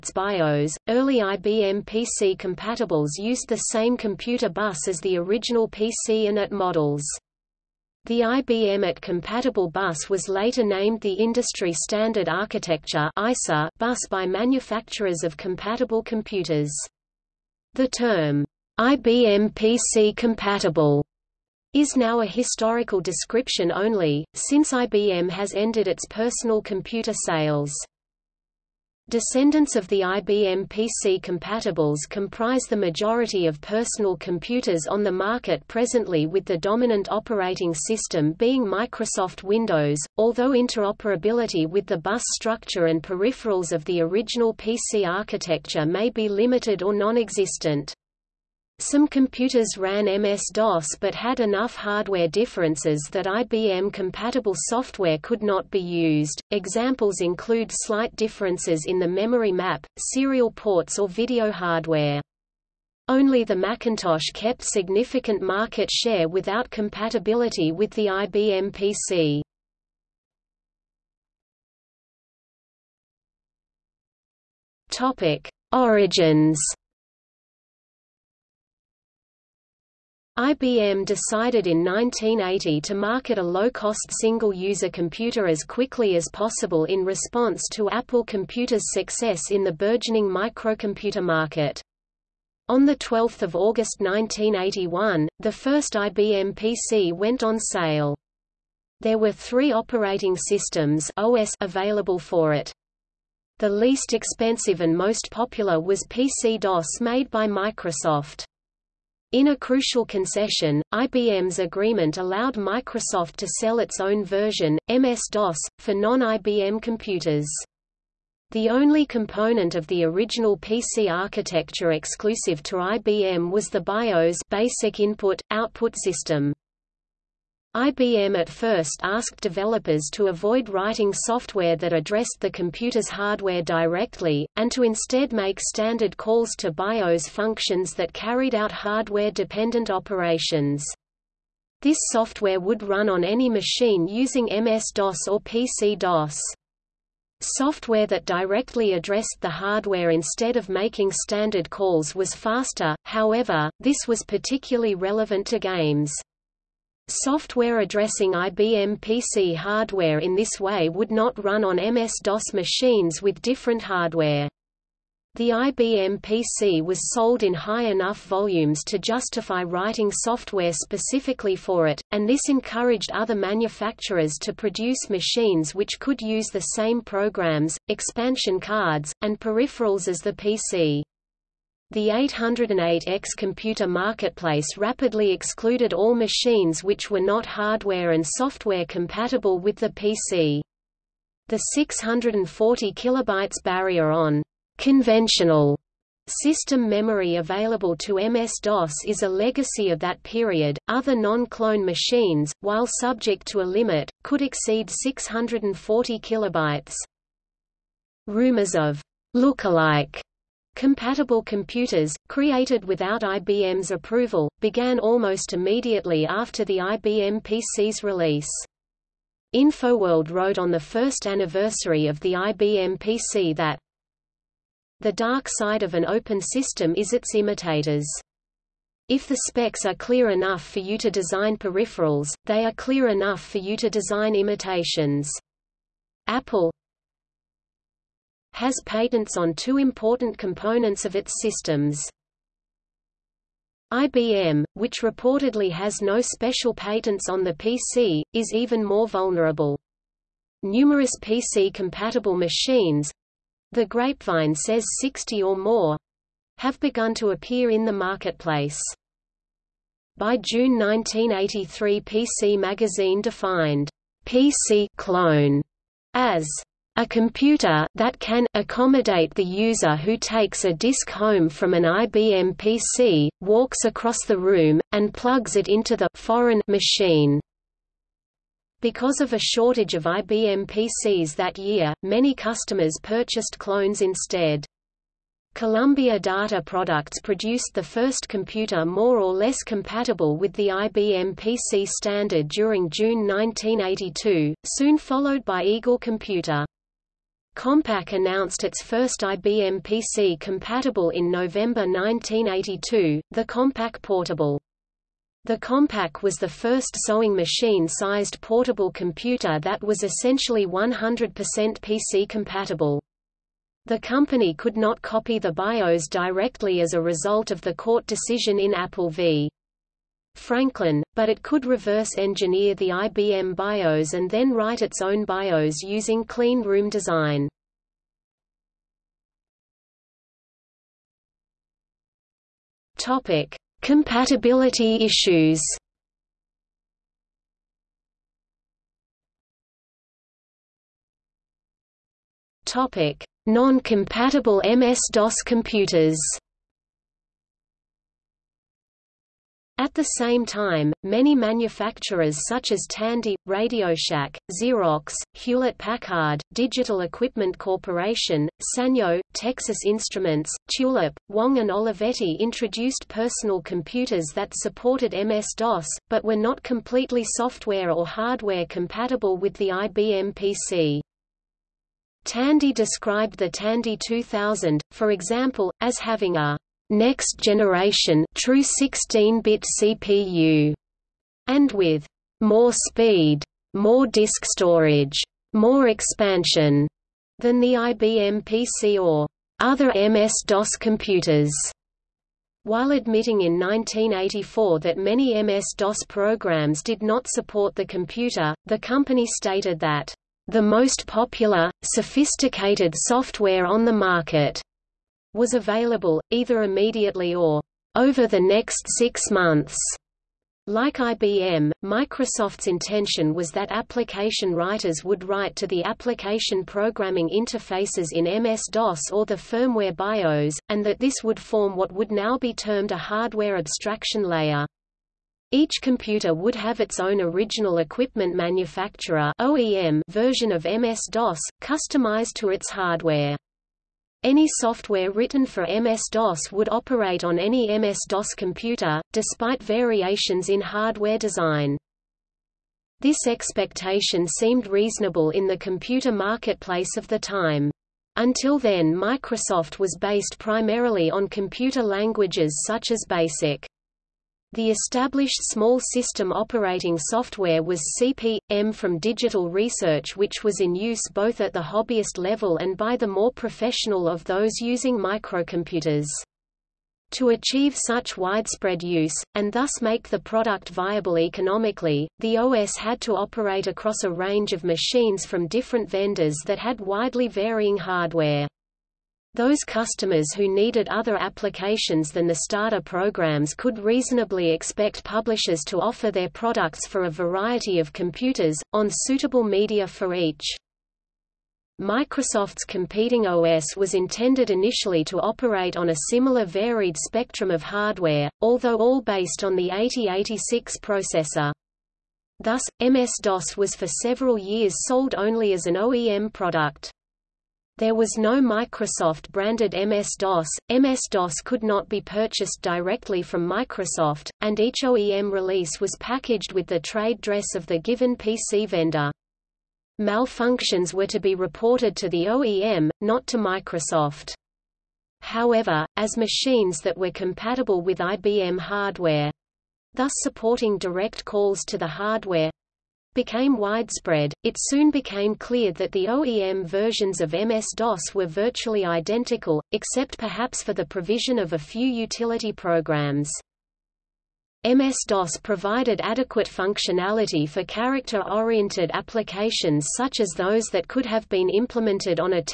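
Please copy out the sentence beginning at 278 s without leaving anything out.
Because of a shortage of IBM PCs that year, many customers purchased clones instead.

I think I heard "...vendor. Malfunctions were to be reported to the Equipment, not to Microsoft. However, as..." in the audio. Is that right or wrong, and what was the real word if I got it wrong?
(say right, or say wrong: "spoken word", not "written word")
wrong: "OEM", not "Equipment".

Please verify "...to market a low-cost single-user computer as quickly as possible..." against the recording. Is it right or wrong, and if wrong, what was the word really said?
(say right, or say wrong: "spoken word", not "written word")
right.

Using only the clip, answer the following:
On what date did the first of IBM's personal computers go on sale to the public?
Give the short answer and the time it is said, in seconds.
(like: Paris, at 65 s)
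12 August 1981, at 92 s.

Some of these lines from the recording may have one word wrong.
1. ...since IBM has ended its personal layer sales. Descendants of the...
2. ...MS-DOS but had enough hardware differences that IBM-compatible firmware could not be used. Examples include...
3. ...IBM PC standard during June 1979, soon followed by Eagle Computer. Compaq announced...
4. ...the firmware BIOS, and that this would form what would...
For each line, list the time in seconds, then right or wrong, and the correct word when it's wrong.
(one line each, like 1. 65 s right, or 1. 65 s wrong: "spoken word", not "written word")
1. 24 s wrong: "computer", not "layer"
2. 50 s wrong: "software", not "firmware"
3. 290 s wrong: "1982", not "1979"
4. 419 s right.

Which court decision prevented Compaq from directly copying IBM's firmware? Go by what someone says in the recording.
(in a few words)
Apple v. 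Franklin.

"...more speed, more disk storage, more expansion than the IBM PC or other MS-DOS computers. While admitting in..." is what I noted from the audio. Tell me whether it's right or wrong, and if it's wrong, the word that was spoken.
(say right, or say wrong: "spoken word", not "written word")
right.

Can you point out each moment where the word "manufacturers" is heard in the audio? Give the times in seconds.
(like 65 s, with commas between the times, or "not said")
14 s, 173 s, 351 s, 428 s.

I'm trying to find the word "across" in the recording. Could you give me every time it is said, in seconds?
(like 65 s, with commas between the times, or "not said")
273 s, 473 s.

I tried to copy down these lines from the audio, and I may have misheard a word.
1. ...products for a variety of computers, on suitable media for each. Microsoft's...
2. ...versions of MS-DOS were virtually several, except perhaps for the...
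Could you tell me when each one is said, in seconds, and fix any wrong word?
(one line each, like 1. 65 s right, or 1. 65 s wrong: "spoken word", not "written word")
1. 486 s right
2. 536 s wrong: "identical", not "several".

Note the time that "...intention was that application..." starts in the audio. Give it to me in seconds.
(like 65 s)
412 s.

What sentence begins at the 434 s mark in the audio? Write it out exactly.
Any software written for MS-DOS would operate on any MS-DOS computer, despite variations in hardware design.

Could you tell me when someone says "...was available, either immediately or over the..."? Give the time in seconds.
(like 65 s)
405 s.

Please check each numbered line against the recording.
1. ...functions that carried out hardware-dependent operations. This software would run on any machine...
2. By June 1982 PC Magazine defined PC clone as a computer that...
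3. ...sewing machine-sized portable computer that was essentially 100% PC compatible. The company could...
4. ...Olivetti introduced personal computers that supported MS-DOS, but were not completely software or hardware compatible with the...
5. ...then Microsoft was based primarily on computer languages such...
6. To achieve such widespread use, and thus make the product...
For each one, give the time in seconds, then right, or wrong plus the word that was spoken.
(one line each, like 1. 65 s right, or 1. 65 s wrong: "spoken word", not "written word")
1. 137 s right
2. 260 s wrong: "1983", not "1982"
3. 307 s right
4. 361 s right
5. 448 s right
6. 467 s right.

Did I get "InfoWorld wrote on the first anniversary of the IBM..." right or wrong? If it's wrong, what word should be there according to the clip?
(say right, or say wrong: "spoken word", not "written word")
right.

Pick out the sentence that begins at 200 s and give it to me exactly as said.
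Other non-clone machines, while subject to a limit, could exceed 640 kilobytes.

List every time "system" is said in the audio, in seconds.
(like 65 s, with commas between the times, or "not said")
37 s, 100 s, 126 s, 196 s, 226 s, 241 s, 455 s.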